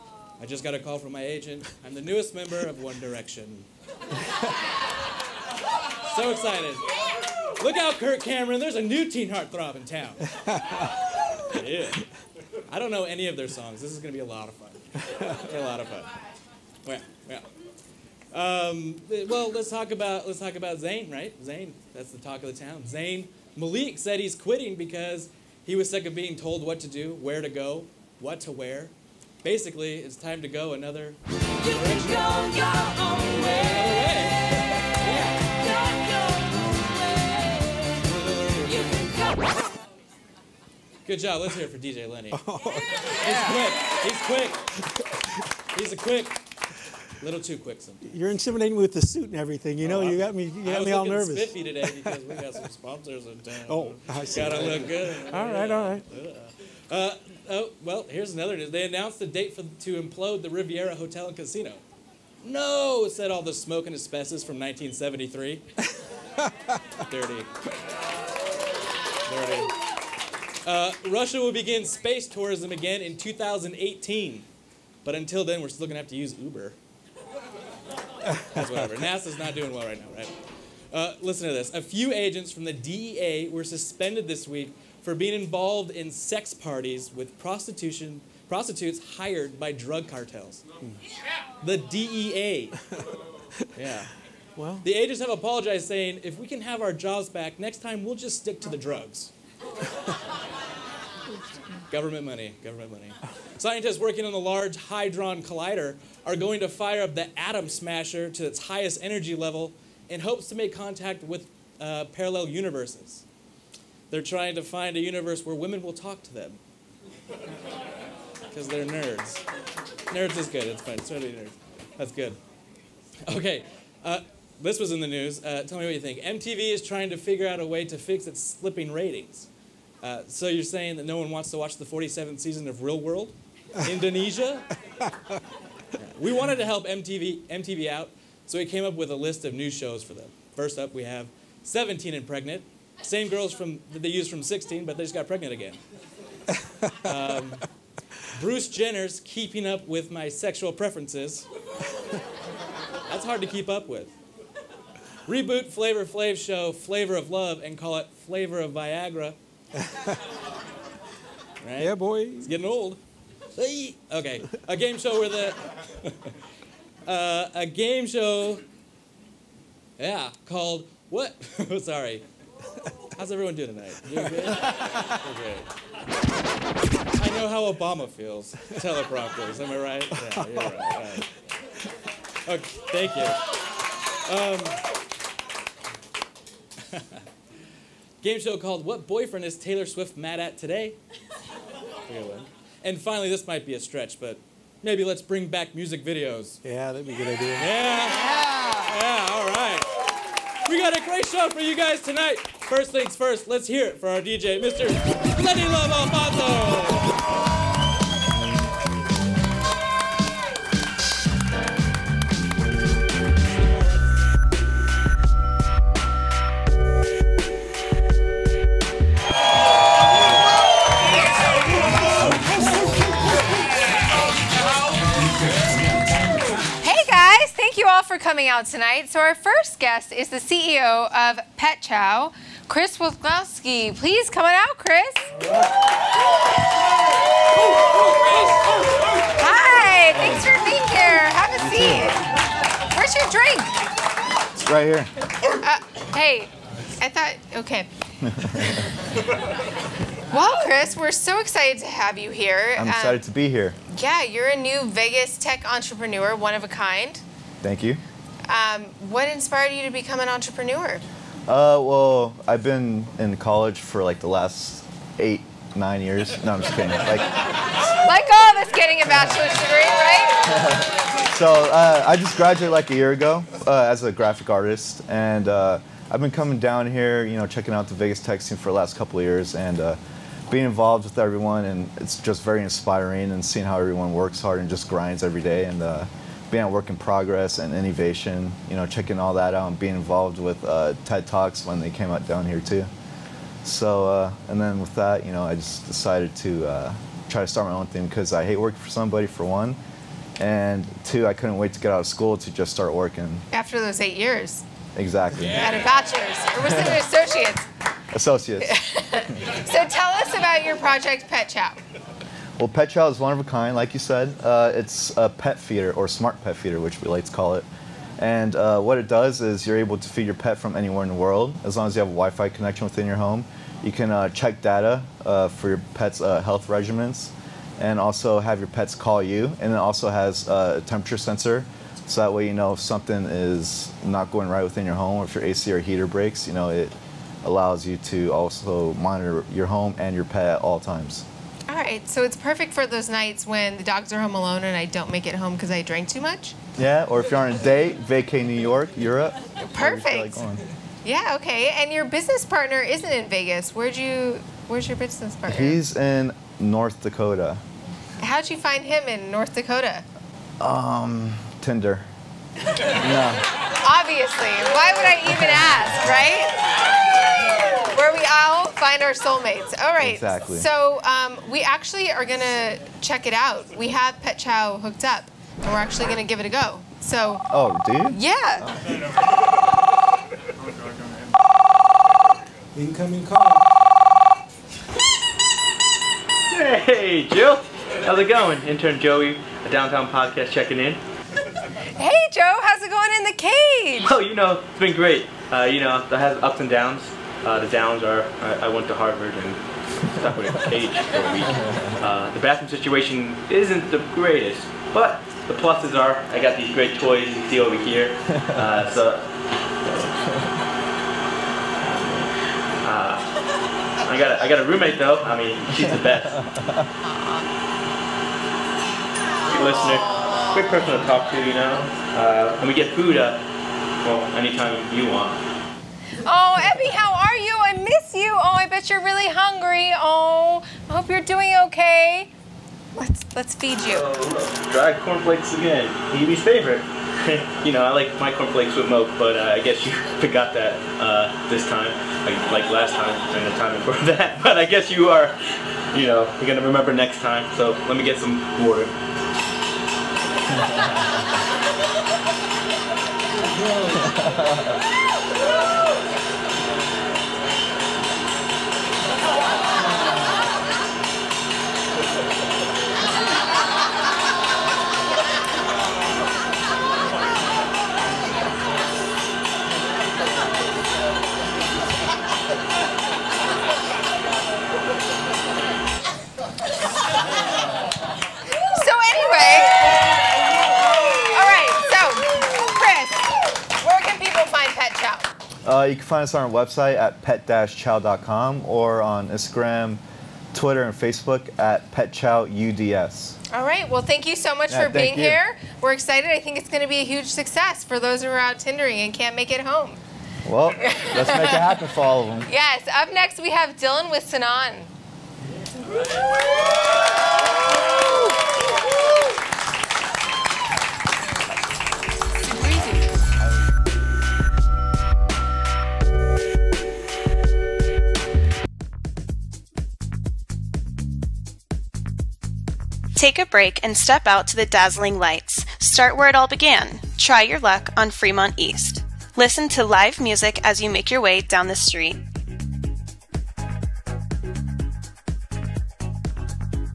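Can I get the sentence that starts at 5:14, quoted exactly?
Uh, it's a pet feeder or smart pet feeder, which we like to call it.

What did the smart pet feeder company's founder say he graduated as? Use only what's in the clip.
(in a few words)
graphic artist.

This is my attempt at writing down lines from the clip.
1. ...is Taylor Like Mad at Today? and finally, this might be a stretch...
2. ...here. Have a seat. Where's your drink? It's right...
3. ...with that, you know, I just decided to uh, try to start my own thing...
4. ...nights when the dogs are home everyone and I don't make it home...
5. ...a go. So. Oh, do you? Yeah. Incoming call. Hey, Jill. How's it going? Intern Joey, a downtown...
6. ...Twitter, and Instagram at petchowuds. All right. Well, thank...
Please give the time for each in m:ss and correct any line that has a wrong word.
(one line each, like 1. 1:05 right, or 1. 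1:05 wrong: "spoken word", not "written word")
1. 3:09 wrong: "Swift", not "Like"
2. 4:00 right
3. 4:54 right
4. 5:43 wrong: "alone", not "everyone"
5. 6:16 right
6. 8:10 wrong: "Facebook", not "Instagram".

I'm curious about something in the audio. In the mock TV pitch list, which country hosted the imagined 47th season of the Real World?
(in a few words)
Indonesia.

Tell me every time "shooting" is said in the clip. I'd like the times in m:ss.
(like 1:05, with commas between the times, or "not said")
not said.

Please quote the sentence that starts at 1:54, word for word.
They're trying to find a universe where women will talk to them.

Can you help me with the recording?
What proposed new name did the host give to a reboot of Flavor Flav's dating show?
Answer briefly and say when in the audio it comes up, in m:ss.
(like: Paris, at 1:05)
Flavor of Viagra, at 2:38.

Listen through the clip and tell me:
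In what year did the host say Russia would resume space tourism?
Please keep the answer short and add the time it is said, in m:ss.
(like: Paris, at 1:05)
2018, at 1:13.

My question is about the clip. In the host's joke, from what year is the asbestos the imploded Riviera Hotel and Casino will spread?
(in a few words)
1973.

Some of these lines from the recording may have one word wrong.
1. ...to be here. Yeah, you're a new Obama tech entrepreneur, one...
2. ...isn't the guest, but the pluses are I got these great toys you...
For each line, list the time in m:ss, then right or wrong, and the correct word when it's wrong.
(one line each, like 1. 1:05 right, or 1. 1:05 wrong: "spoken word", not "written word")
1. 4:13 wrong: "Vegas", not "Obama"
2. 6:43 wrong: "greatest", not "guest".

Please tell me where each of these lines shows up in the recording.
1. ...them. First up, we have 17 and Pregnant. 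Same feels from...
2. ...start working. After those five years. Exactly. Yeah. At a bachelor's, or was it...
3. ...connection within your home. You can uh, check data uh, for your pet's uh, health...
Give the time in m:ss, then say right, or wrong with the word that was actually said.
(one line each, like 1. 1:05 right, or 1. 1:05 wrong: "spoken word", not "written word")
1. 2:20 wrong: "girls", not "feels"
2. 5:02 wrong: "eight", not "five"
3. 5:22 right.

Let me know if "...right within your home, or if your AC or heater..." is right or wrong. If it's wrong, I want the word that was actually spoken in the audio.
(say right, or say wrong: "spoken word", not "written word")
right.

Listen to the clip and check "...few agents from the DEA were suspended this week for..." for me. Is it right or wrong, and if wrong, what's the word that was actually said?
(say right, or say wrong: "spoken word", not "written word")
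right.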